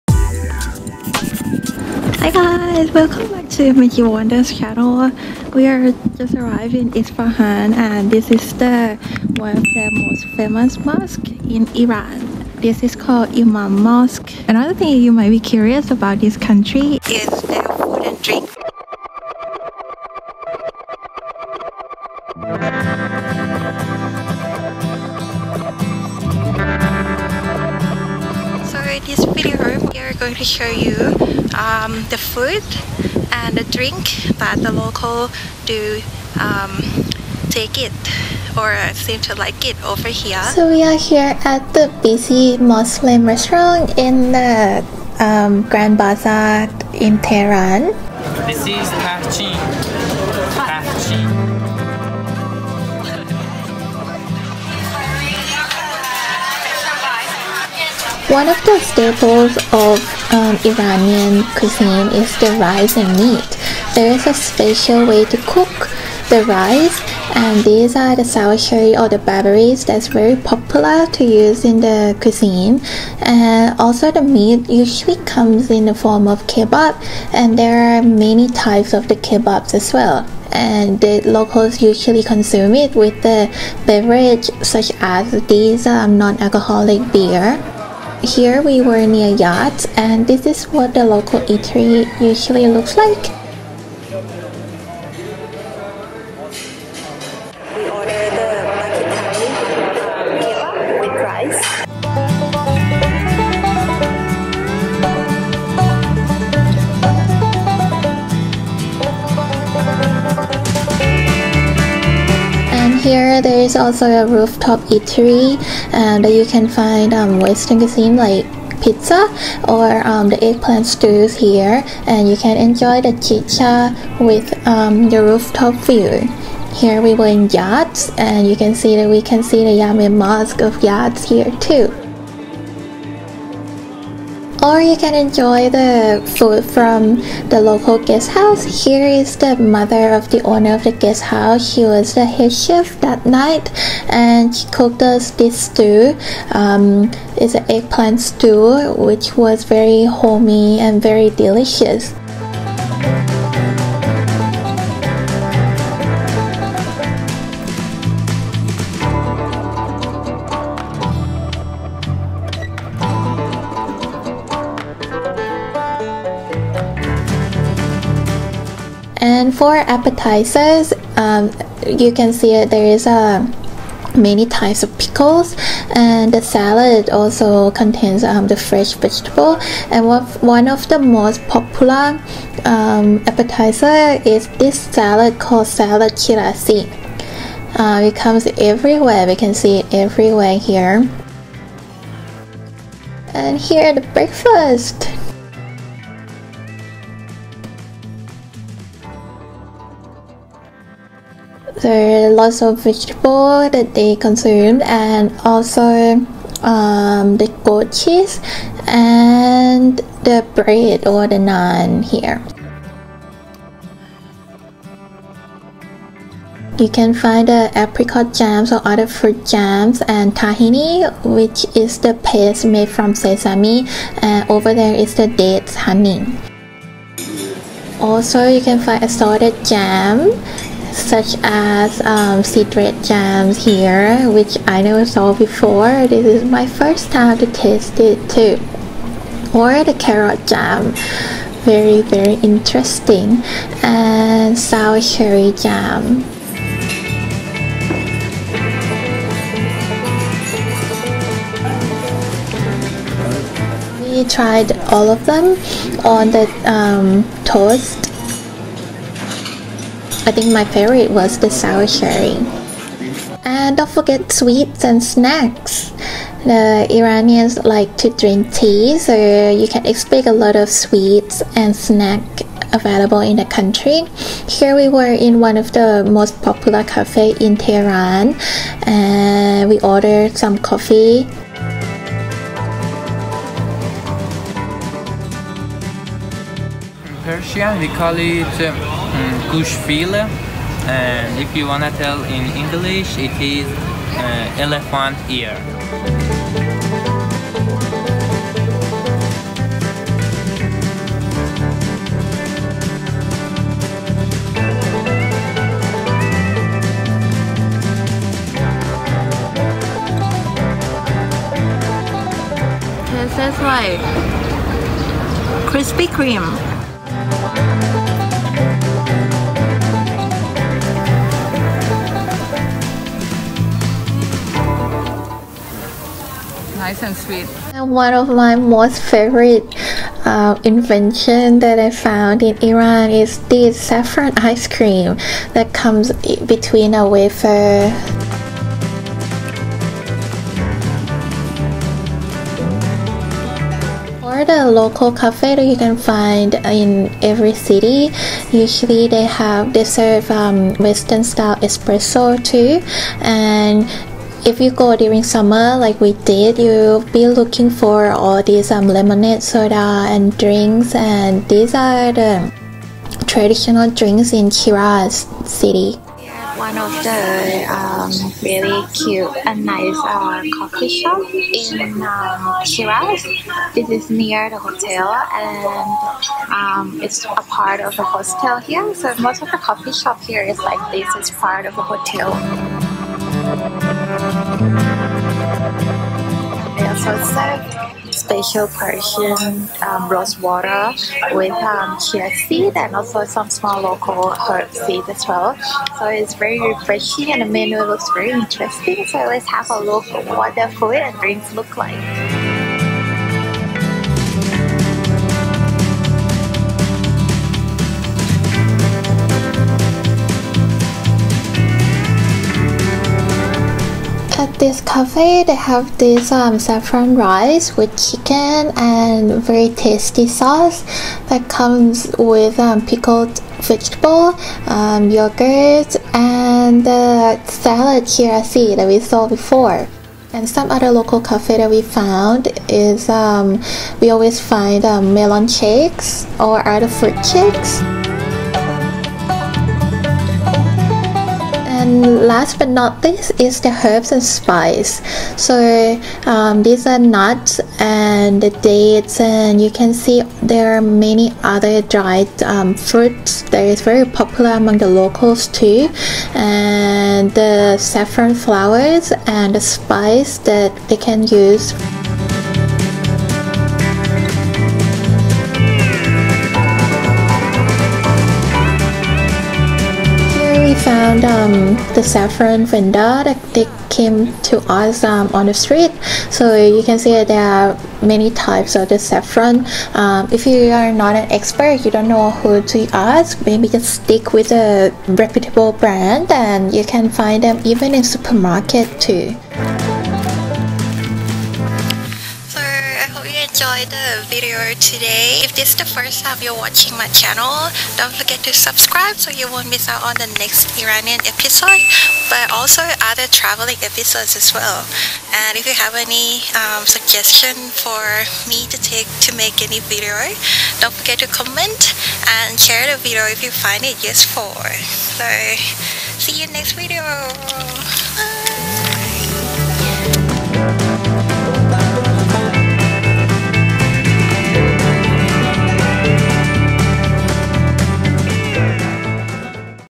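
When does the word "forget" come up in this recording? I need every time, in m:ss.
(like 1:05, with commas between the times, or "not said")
4:23, 8:18, 8:30.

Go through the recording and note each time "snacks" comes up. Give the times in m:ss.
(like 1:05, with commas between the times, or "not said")
4:25, 4:31.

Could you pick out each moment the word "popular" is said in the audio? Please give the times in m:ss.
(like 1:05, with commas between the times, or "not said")
1:10, 3:01, 4:36, 7:34.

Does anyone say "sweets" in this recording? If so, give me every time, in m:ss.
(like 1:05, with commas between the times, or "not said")
4:24, 4:30, 5:27.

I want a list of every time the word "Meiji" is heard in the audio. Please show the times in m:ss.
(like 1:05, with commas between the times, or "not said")
0:03.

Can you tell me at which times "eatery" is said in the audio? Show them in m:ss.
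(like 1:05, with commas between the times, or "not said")
1:31, 1:54.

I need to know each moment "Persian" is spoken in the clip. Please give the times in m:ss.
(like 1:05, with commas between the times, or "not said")
4:47, 6:28.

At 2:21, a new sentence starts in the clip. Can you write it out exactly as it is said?
She was the head chef that night and she cooked us this stew.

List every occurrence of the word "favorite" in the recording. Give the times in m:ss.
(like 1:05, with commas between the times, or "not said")
4:20, 5:29.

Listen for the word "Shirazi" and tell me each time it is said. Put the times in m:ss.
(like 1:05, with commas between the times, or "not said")
3:06, 7:08.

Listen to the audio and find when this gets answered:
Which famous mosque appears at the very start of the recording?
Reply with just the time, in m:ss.
0:13.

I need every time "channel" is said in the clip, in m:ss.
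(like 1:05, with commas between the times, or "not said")
0:04, 8:17.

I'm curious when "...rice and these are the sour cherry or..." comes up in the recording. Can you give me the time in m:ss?
1:06.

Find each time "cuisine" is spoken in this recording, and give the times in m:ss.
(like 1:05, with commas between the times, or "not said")
1:01, 1:12, 1:57.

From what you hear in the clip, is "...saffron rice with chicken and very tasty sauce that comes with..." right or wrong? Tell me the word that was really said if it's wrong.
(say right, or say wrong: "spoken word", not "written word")
right.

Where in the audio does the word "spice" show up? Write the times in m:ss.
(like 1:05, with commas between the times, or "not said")
7:24, 7:39.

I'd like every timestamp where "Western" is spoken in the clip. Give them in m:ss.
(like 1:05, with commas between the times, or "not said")
1:57, 5:50.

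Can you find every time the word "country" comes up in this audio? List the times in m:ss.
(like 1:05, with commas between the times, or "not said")
0:16, 4:33.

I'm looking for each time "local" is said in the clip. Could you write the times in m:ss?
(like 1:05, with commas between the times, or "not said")
0:34, 1:21, 1:31, 2:17, 5:44, 6:33, 7:10, 7:34.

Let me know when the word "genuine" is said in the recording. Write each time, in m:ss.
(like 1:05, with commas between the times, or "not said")
not said.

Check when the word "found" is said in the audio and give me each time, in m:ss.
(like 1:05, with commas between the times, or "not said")
5:31, 7:11.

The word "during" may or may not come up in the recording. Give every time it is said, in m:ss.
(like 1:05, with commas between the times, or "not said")
5:54.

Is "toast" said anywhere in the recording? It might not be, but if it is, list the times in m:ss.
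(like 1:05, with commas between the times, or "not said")
4:17.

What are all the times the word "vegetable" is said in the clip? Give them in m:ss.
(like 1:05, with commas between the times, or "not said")
2:58, 3:22, 7:03.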